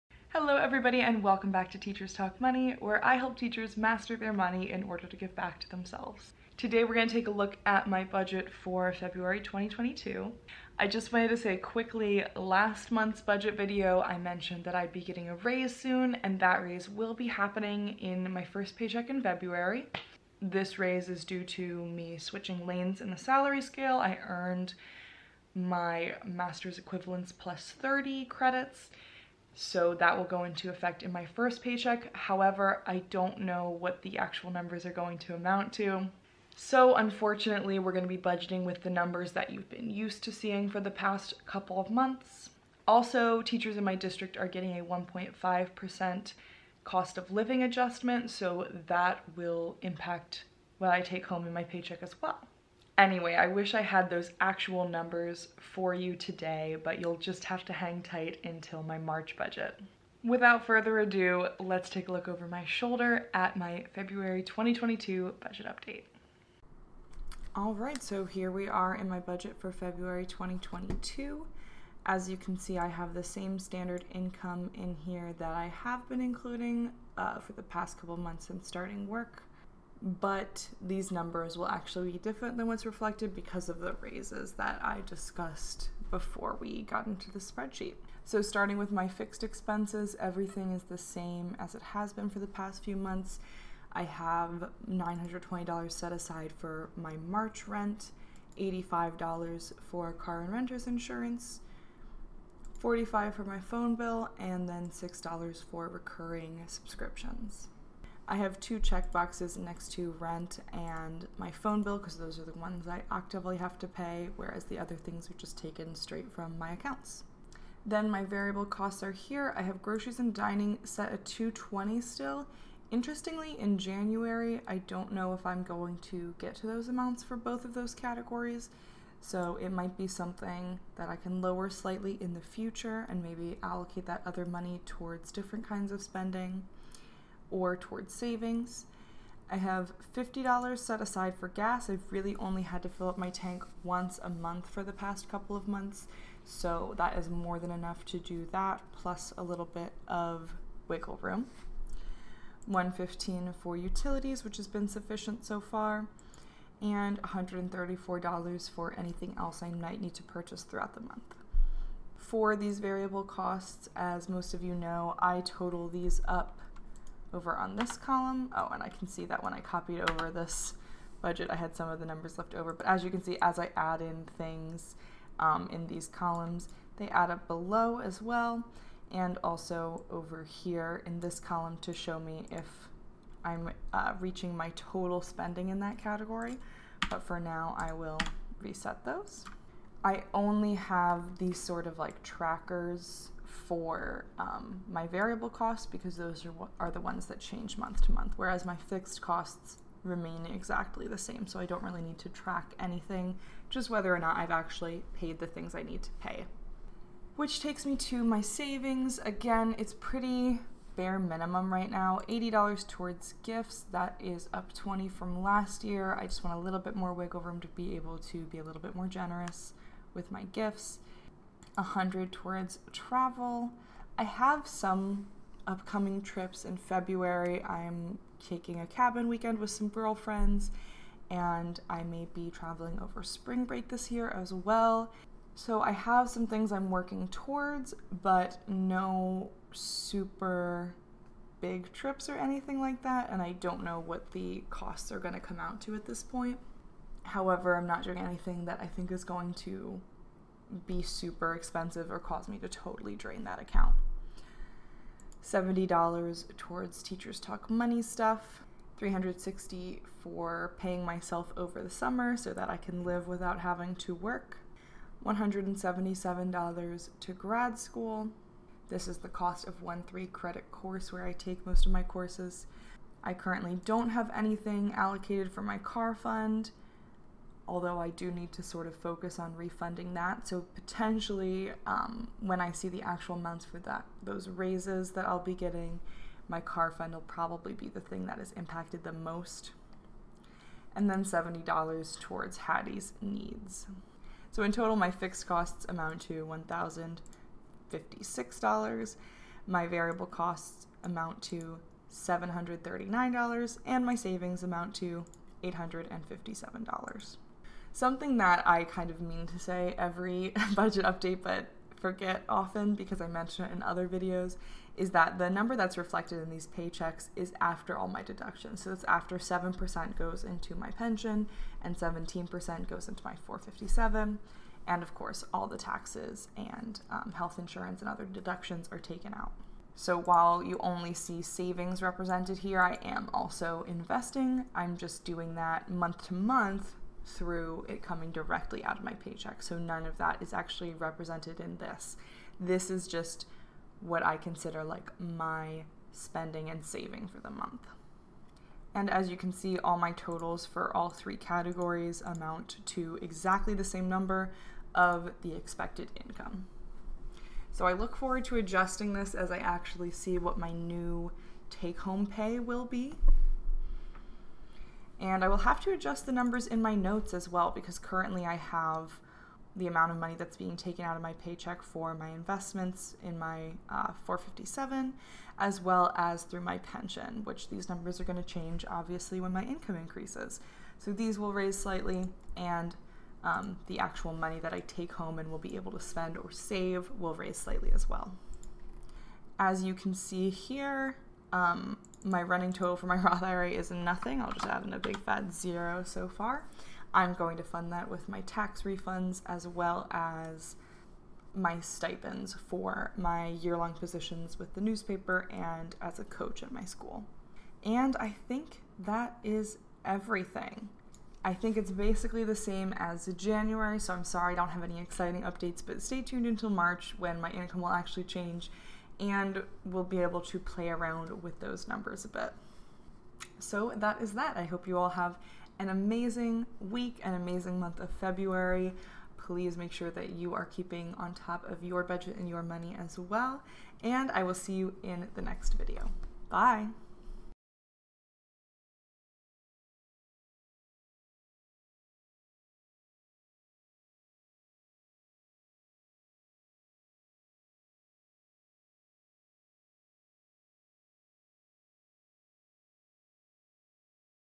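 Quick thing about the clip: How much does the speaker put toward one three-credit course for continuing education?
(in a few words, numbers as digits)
$177.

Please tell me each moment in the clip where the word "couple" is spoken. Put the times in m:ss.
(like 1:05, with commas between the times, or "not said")
0:41, 1:17, 2:25.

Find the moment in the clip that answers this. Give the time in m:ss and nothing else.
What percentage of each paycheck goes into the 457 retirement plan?
5:21.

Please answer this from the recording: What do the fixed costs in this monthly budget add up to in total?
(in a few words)
$1,056.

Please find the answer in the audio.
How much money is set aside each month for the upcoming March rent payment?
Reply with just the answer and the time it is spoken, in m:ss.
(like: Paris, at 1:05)
$920, at 1:34.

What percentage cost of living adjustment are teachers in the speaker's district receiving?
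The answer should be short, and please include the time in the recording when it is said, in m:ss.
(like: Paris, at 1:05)
1.5%, at 0:44.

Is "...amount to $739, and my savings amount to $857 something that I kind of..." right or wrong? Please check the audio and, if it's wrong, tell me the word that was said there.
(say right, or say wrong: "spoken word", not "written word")
right.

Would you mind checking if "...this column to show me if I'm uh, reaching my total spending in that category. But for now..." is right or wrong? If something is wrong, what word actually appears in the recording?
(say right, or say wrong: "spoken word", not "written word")
right.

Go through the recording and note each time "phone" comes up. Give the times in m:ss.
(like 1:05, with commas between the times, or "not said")
1:43, 1:51.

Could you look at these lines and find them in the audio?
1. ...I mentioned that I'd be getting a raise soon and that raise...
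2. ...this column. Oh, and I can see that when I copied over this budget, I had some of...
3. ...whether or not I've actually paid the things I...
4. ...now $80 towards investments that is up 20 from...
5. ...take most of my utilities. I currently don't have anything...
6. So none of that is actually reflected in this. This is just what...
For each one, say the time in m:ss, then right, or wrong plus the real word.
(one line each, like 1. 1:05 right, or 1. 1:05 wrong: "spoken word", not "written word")
1. 0:14 right
2. 2:47 right
3. 3:23 right
4. 3:31 wrong: "gifts", not "investments"
5. 4:31 wrong: "courses", not "utilities"
6. 5:39 wrong: "represented", not "reflected".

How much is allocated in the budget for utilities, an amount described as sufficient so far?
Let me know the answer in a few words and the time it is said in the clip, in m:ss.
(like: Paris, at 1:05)
$115, at 2:32.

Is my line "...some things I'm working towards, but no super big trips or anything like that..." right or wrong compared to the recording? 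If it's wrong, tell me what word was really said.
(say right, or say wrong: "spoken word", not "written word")
right.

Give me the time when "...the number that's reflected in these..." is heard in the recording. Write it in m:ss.
5:15.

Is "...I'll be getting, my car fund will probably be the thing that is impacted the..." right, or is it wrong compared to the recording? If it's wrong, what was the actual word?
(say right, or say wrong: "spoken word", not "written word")
right.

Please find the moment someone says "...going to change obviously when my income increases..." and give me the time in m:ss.
6:18.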